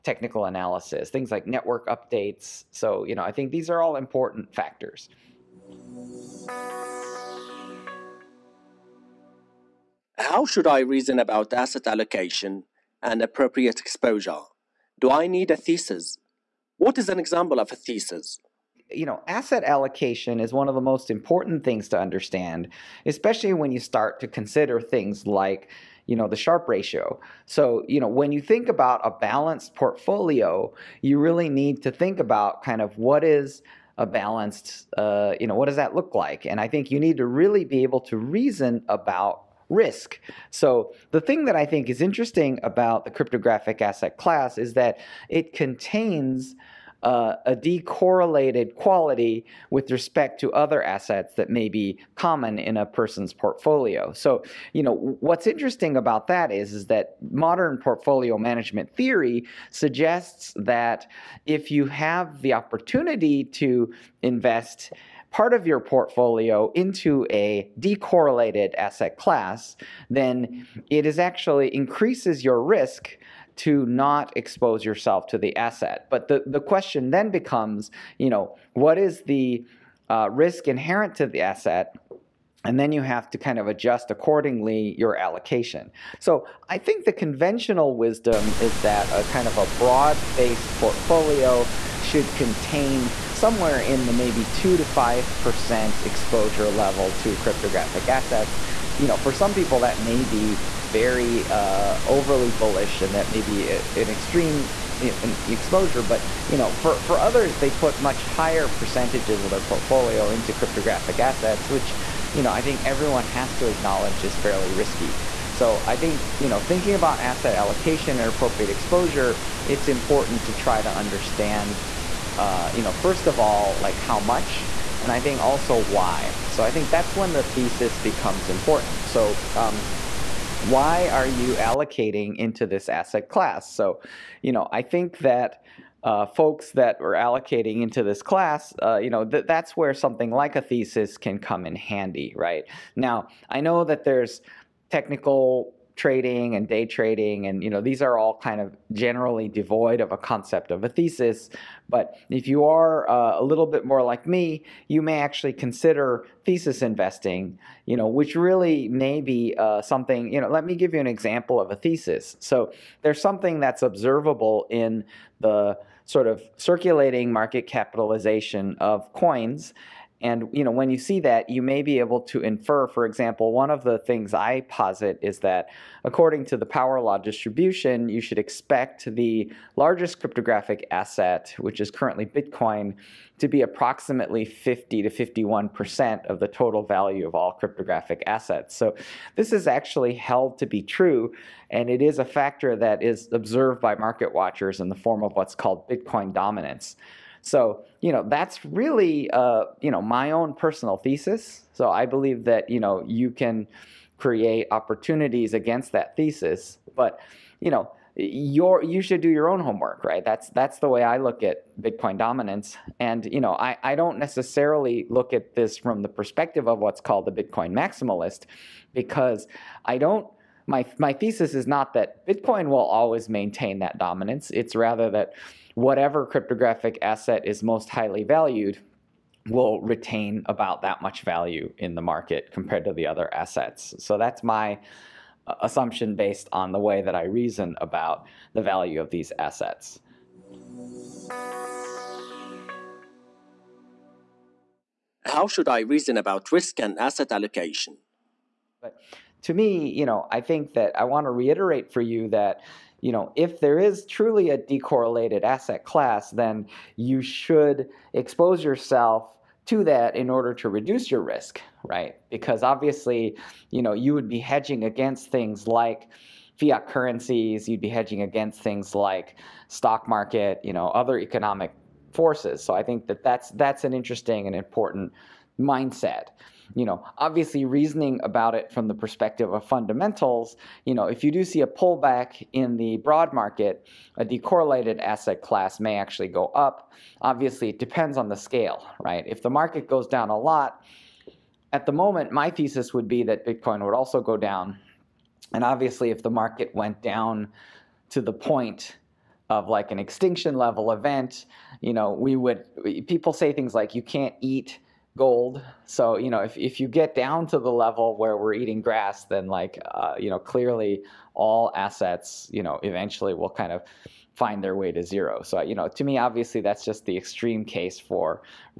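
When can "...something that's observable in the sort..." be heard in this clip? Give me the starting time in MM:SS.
02:43.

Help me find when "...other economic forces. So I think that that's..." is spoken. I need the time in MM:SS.
04:30.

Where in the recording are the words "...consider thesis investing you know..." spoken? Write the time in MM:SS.
02:35.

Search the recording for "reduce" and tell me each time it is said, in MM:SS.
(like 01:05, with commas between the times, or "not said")
04:20.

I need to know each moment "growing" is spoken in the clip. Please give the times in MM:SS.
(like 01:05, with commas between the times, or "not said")
not said.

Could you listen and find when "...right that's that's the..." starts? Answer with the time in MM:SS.
03:30.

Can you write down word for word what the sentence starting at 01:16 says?
But the, the question then becomes, you know, what is the uh, risk inherent to the asset?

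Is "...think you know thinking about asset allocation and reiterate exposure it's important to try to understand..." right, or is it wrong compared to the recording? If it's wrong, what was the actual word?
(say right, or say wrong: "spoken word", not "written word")
wrong: "appropriate", not "reiterate".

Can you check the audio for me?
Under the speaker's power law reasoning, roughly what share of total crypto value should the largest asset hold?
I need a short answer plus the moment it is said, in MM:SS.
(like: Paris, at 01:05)
50 to 51%, at 03:04.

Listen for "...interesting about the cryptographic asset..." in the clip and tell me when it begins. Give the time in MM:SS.
00:42.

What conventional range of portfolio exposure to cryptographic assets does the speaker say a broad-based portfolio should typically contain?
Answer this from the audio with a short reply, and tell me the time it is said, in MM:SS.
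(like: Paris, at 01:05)
2 to 5%, at 01:34.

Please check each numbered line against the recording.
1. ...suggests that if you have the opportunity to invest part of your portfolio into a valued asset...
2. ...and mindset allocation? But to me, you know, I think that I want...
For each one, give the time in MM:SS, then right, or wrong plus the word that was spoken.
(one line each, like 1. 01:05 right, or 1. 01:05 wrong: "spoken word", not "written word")
1. 00:59 wrong: "decorrelated", not "valued"
2. 04:06 wrong: "asset", not "mindset".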